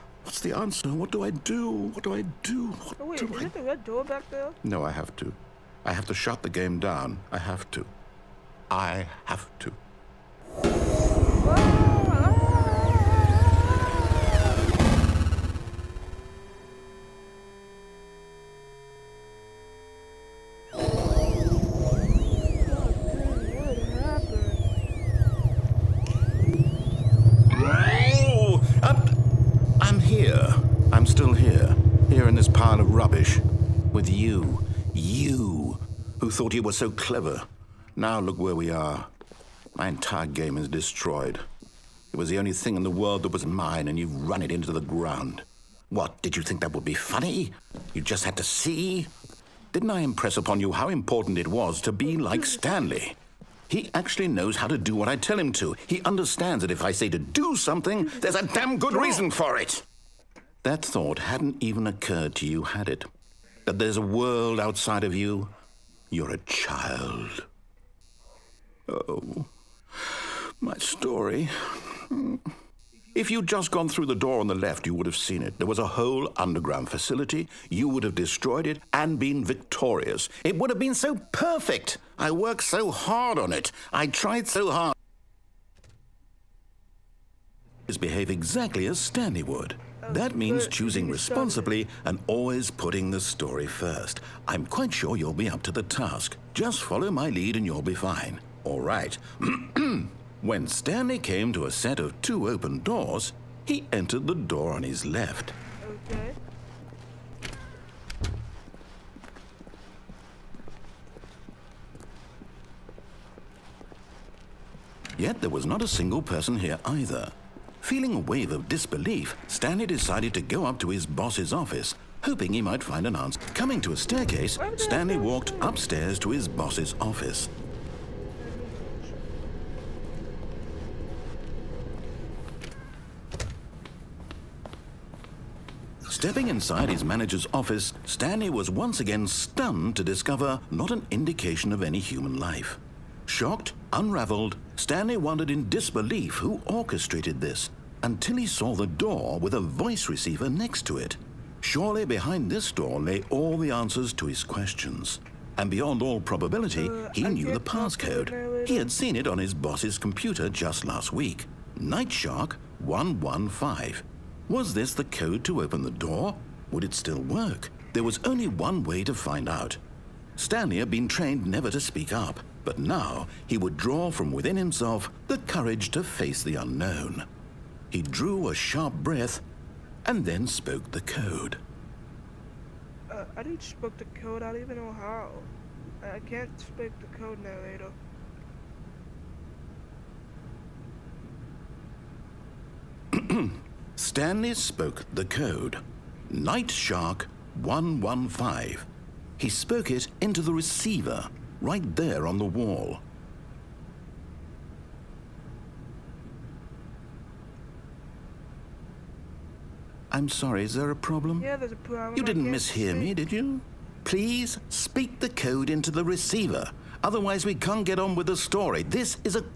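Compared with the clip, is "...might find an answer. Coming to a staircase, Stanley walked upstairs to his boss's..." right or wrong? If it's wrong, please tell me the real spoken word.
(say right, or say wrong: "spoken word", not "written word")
right.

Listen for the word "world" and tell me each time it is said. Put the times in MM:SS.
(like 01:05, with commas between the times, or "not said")
00:42, 01:04.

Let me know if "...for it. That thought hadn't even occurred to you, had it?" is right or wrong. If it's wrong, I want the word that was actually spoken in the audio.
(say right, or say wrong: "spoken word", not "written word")
right.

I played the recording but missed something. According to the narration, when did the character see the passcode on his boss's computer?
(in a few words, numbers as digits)
Last week.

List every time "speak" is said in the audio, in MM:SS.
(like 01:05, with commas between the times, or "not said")
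02:51, 03:06, 03:34.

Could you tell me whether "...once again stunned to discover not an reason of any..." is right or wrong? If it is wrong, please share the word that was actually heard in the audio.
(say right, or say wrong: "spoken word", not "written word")
wrong: "indication", not "reason".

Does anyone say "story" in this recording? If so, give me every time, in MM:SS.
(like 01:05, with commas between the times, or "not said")
01:10, 01:33, 03:38.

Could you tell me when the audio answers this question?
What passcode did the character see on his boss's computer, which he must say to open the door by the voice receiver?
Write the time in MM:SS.
02:41.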